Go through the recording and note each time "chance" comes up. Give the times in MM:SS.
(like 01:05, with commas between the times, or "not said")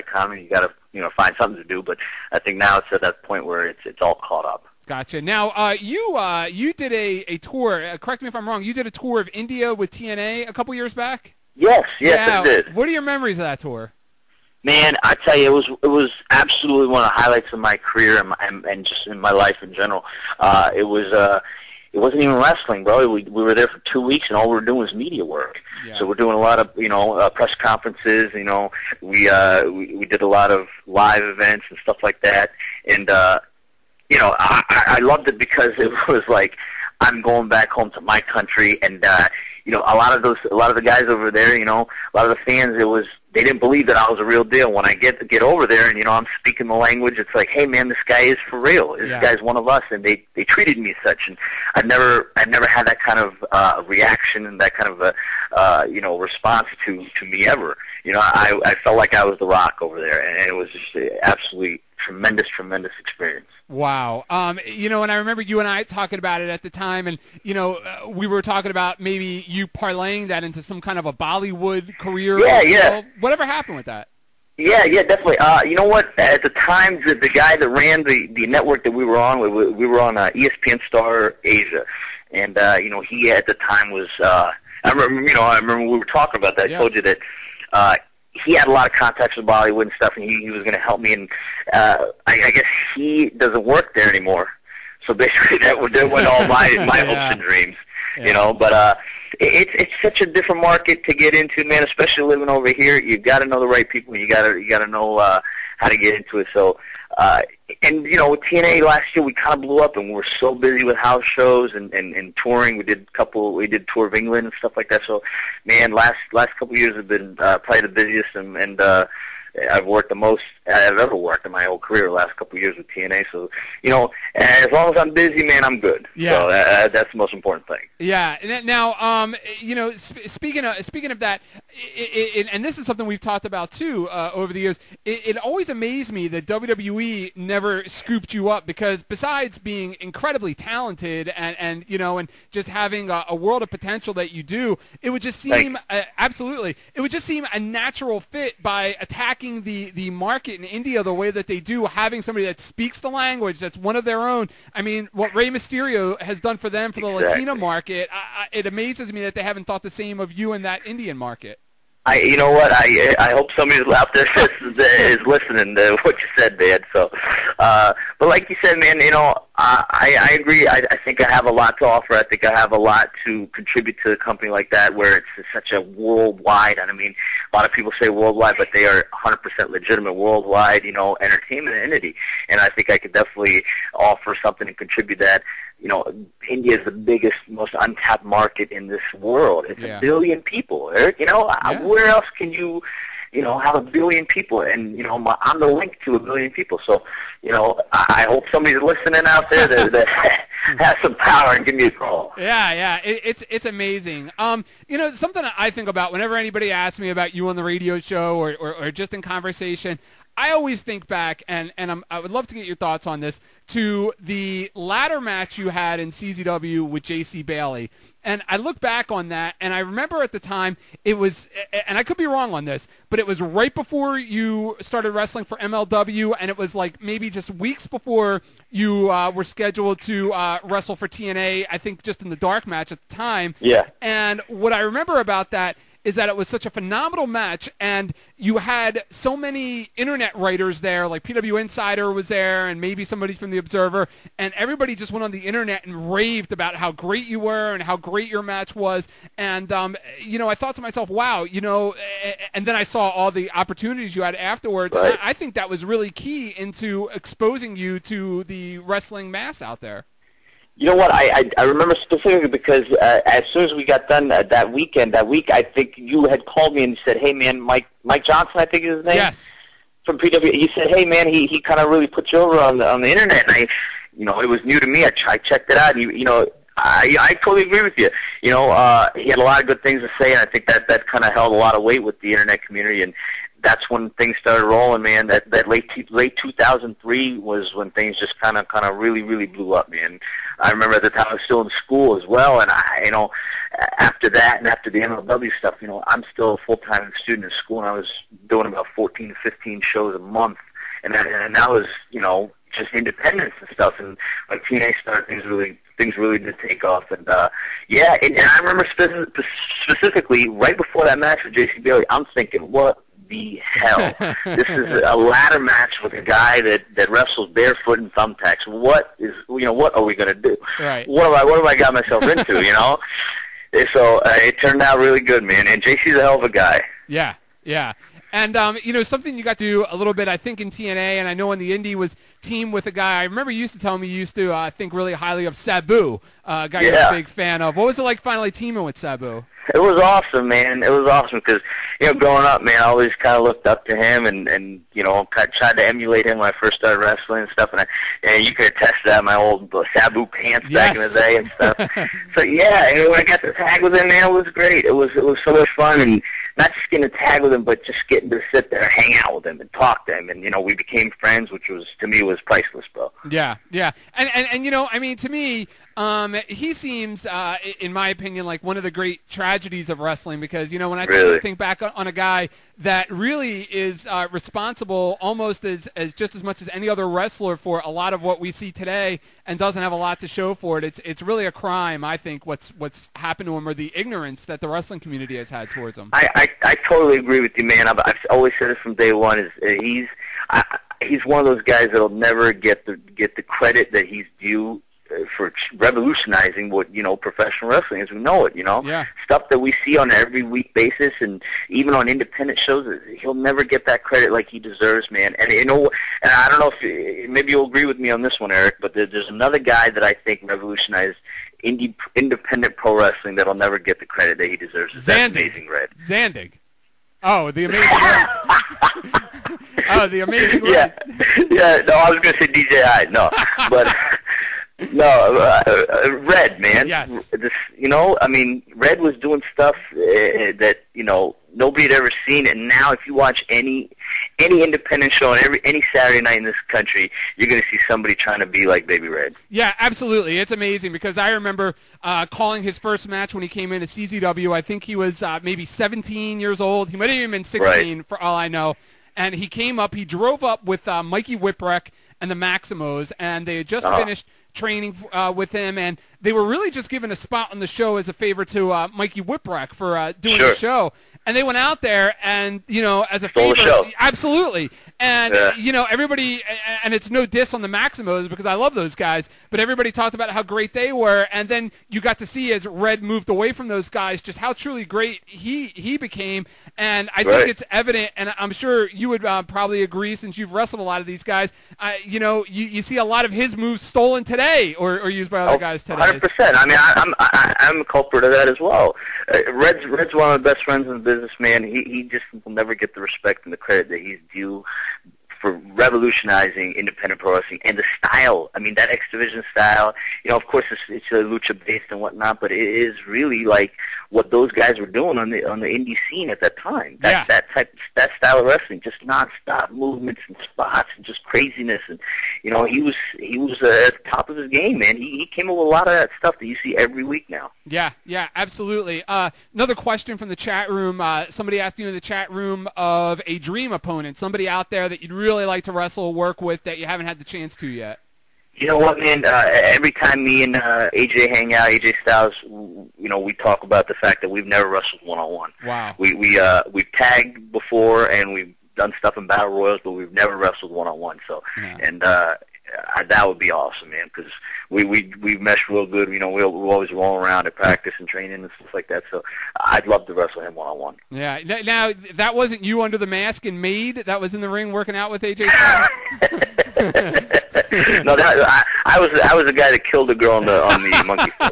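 08:47.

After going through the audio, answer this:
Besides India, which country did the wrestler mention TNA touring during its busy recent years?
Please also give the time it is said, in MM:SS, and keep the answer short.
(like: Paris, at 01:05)
England, at 01:54.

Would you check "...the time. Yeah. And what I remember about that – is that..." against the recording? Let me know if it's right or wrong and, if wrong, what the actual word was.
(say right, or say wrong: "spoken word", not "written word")
right.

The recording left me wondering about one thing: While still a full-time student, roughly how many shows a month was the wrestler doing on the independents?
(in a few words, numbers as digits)
14 to 15.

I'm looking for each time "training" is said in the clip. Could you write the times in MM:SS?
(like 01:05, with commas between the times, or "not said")
07:34, 09:08.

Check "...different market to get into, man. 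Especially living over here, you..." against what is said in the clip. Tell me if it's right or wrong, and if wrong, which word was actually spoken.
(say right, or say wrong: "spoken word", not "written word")
right.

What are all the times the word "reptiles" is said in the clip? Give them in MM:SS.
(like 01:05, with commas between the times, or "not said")
not said.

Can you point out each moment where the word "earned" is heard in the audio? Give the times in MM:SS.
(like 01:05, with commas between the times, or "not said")
not said.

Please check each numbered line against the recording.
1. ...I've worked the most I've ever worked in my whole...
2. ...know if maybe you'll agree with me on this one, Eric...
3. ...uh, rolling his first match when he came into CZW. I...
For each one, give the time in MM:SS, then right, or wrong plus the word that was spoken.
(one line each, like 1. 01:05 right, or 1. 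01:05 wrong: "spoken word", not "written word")
1. 01:59 right
2. 06:46 right
3. 07:22 wrong: "calling", not "rolling".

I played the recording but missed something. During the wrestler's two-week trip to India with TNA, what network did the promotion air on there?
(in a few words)
ESPN Star Asia.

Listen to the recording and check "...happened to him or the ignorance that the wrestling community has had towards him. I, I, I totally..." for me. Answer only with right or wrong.
right.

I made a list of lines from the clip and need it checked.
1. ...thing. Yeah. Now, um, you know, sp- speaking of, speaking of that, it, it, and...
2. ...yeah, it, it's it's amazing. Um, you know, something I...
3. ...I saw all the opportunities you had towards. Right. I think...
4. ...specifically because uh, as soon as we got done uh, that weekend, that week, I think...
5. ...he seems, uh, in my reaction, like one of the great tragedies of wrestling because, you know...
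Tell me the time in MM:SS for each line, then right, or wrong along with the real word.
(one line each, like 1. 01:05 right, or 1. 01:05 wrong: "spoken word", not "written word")
1. 02:07 right
2. 03:22 right
3. 04:12 wrong: "afterwards", not "towards"
4. 04:21 right
5. 06:06 wrong: "opinion", not "reaction".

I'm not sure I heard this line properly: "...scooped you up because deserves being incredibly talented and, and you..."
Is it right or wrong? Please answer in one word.
wrong.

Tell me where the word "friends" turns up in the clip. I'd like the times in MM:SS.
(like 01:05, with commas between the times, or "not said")
06:01, 08:10.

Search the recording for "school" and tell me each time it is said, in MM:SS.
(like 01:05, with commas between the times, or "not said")
04:51, 04:57.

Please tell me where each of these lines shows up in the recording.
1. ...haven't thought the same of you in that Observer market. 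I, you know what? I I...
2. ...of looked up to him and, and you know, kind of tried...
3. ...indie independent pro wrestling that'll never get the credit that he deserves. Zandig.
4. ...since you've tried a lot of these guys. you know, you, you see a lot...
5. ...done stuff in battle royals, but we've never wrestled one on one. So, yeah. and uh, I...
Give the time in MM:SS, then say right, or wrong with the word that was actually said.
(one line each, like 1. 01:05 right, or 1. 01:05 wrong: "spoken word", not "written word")
1. 02:39 wrong: "Indian", not "Observer"
2. 05:43 right
3. 06:51 right
4. 08:00 wrong: "wrestled", not "tried"
5. 08:58 right.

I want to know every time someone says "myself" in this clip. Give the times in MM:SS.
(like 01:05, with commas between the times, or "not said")
04:10, 05:21.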